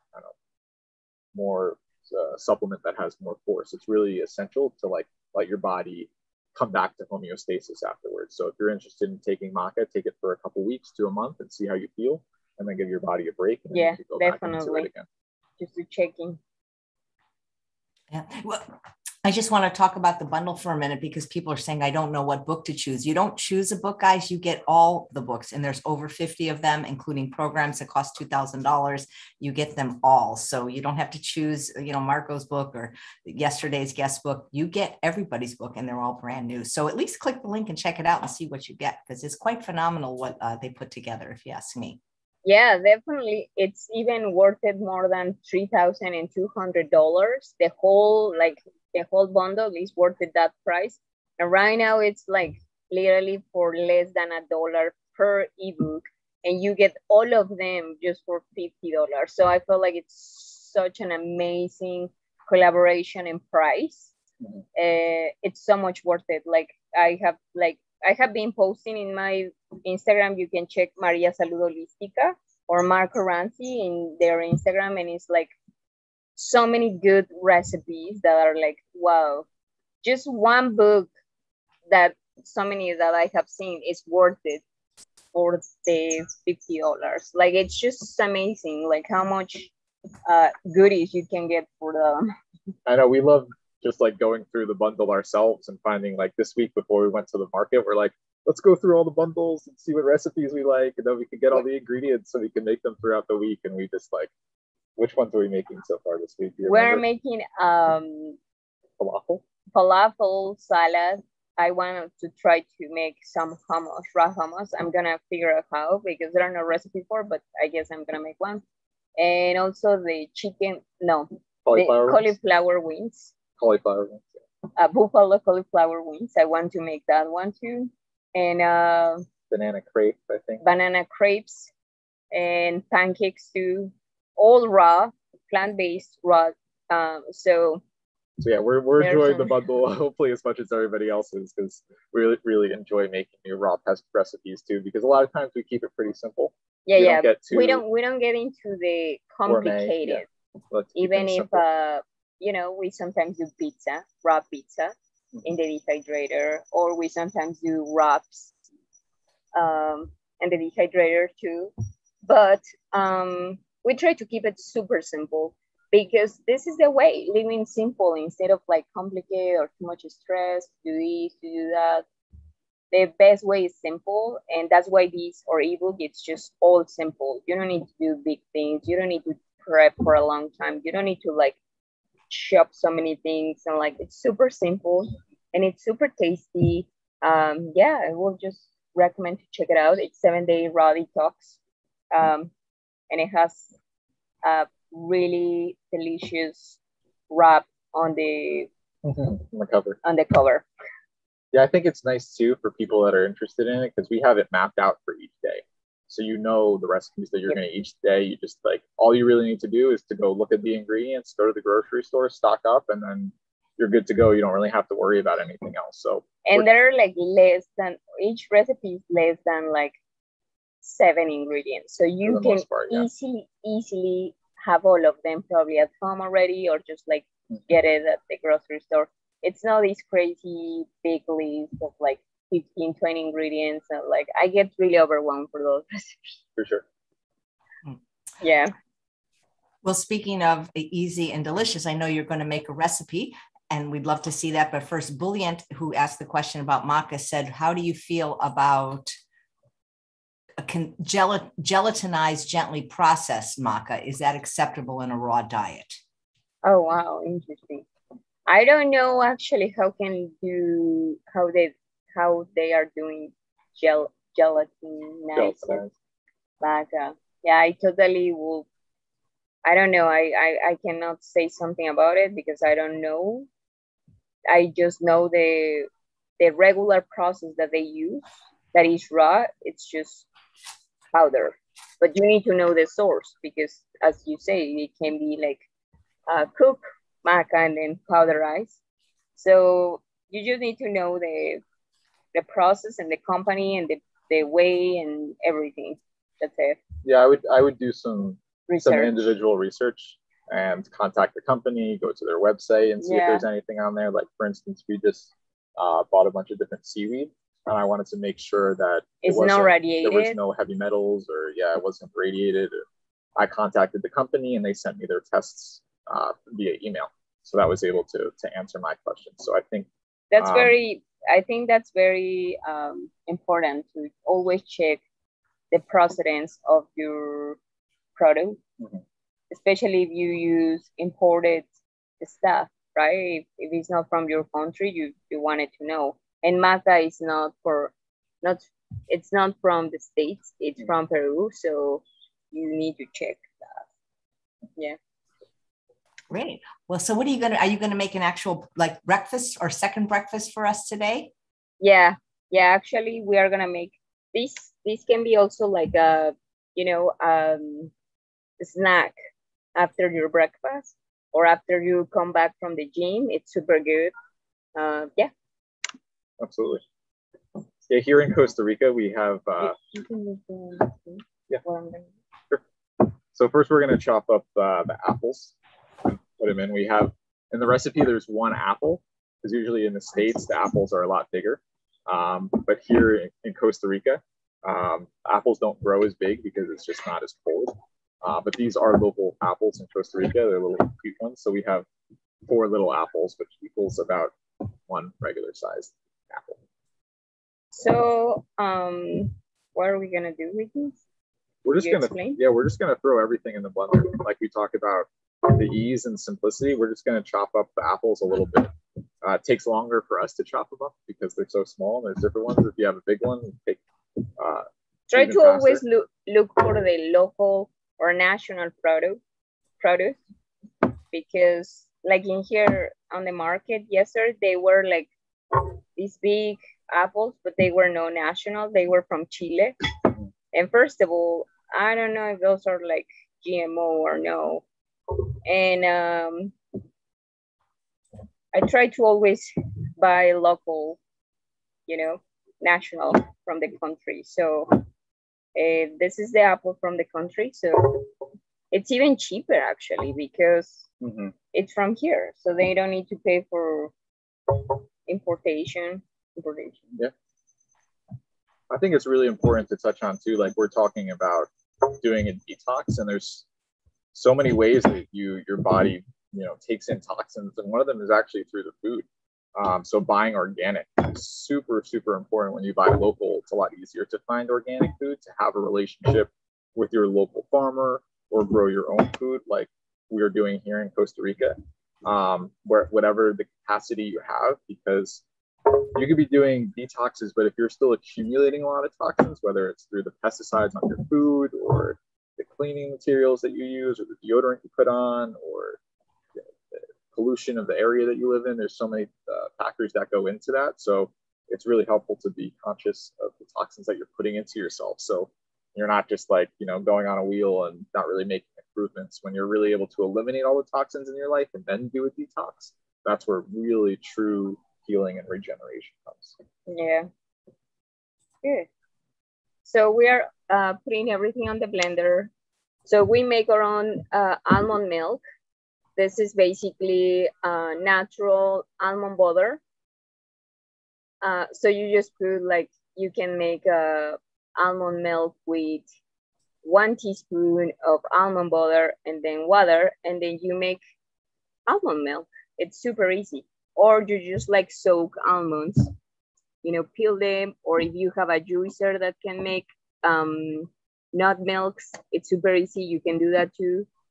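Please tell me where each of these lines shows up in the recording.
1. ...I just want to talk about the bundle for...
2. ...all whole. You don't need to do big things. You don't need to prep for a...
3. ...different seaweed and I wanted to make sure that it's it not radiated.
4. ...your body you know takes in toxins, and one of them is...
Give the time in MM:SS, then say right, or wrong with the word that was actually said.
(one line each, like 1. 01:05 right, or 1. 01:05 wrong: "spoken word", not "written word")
1. 00:19 right
2. 02:56 wrong: "simple", not "whole"
3. 05:06 right
4. 07:45 right.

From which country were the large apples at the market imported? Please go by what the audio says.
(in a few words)
Chile.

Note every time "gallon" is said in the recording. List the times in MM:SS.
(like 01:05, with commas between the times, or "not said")
not said.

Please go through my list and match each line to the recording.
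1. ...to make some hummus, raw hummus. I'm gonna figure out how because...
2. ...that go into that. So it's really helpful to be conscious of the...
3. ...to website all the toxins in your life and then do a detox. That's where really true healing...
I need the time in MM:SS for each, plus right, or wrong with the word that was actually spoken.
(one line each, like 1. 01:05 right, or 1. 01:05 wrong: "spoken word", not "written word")
1. 01:52 right
2. 08:19 right
3. 08:29 wrong: "eliminate", not "website".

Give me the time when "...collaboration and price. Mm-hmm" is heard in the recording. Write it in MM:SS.
01:02.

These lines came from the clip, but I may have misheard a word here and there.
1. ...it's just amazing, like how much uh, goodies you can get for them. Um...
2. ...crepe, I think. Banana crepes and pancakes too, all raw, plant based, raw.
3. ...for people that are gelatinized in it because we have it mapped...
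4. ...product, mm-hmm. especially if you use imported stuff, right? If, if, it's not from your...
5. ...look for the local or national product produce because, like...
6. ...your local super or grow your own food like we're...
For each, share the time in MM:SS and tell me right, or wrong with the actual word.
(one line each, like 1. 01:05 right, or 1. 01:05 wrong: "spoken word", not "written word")
1. 01:27 right
2. 02:09 right
3. 03:22 wrong: "interested", not "gelatinized"
4. 05:28 right
5. 06:56 right
6. 07:56 wrong: "farmer", not "super".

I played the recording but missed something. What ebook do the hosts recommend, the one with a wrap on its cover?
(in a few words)
Seven Day Raw Detox.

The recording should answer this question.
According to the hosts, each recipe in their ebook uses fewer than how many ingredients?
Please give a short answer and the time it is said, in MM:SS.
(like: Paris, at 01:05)
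7, at 03:40.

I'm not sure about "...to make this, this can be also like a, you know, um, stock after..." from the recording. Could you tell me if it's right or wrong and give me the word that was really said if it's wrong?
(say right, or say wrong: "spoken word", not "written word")
wrong: "snack", not "stock".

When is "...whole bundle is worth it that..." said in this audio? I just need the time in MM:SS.
00:49.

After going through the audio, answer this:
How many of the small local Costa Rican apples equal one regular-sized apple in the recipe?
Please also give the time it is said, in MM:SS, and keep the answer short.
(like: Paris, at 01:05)
4, at 06:32.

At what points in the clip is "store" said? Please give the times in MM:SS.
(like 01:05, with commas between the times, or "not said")
03:32, 03:48.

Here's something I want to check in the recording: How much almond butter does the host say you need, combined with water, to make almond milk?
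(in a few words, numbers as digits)
1 teaspoon.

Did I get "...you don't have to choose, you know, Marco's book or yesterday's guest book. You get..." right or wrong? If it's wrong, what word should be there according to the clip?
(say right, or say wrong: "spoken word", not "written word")
right.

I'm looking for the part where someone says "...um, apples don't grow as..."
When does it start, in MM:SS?
06:24.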